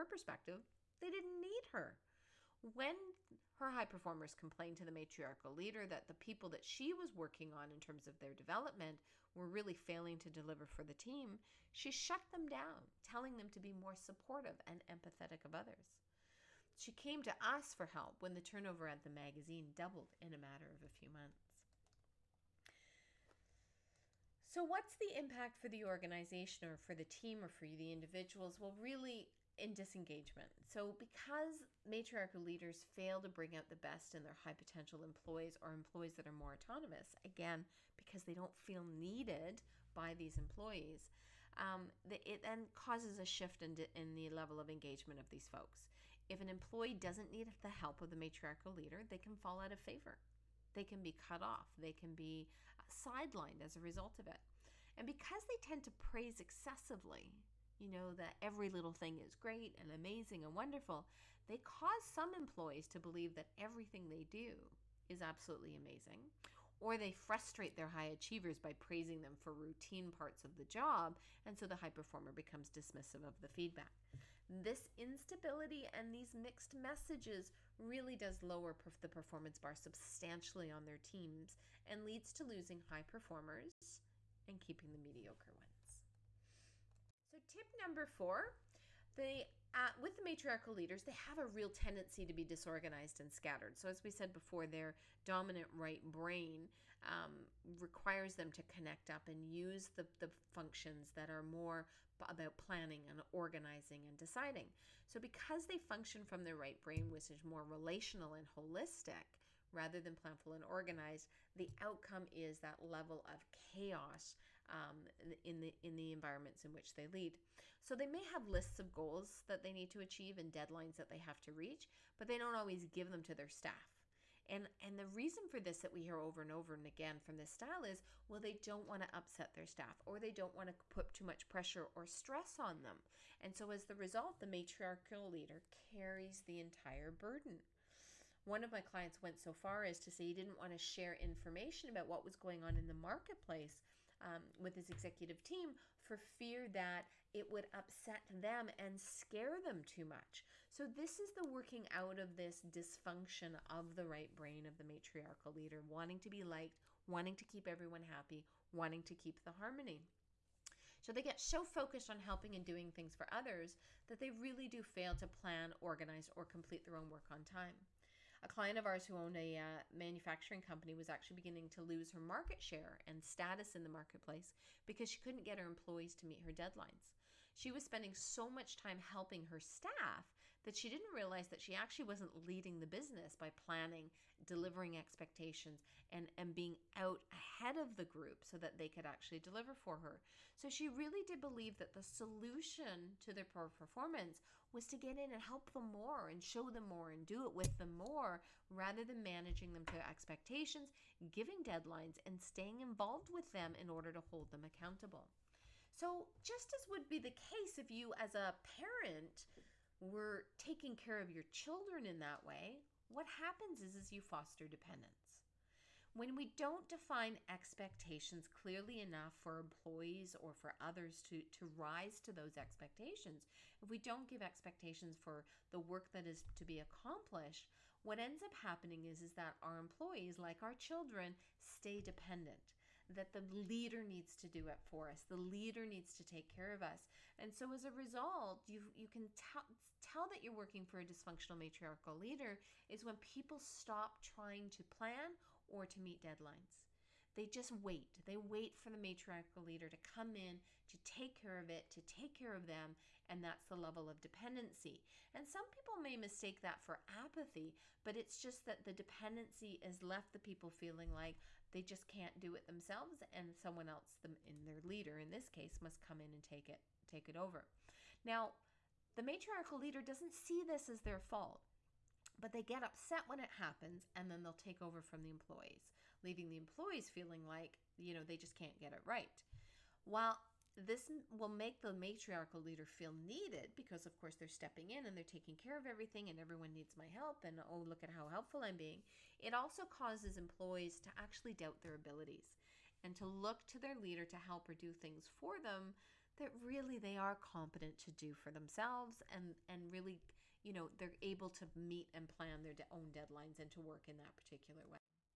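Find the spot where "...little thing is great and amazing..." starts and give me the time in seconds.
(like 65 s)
58 s.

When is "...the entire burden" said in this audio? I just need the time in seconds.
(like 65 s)
136 s.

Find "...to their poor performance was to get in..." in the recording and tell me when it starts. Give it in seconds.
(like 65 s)
193 s.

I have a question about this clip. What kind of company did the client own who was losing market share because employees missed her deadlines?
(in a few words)
Manufacturing company.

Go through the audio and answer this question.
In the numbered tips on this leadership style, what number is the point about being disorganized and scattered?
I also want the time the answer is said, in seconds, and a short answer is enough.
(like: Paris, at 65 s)
4, at 88 s.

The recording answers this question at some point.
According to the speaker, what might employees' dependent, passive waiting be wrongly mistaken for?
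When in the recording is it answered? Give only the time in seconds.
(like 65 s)
257 s.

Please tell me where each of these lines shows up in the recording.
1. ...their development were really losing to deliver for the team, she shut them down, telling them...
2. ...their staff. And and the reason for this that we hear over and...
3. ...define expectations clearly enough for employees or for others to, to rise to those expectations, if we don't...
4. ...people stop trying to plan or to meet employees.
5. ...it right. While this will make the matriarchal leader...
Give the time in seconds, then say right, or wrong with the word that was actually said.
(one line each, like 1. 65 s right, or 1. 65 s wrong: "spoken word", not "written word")
1. 8 s wrong: "failing", not "losing"
2. 123 s right
3. 216 s right
4. 243 s wrong: "deadlines", not "employees"
5. 278 s right.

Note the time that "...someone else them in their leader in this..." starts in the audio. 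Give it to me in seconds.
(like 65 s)
263 s.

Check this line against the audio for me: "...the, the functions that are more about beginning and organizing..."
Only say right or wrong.
wrong.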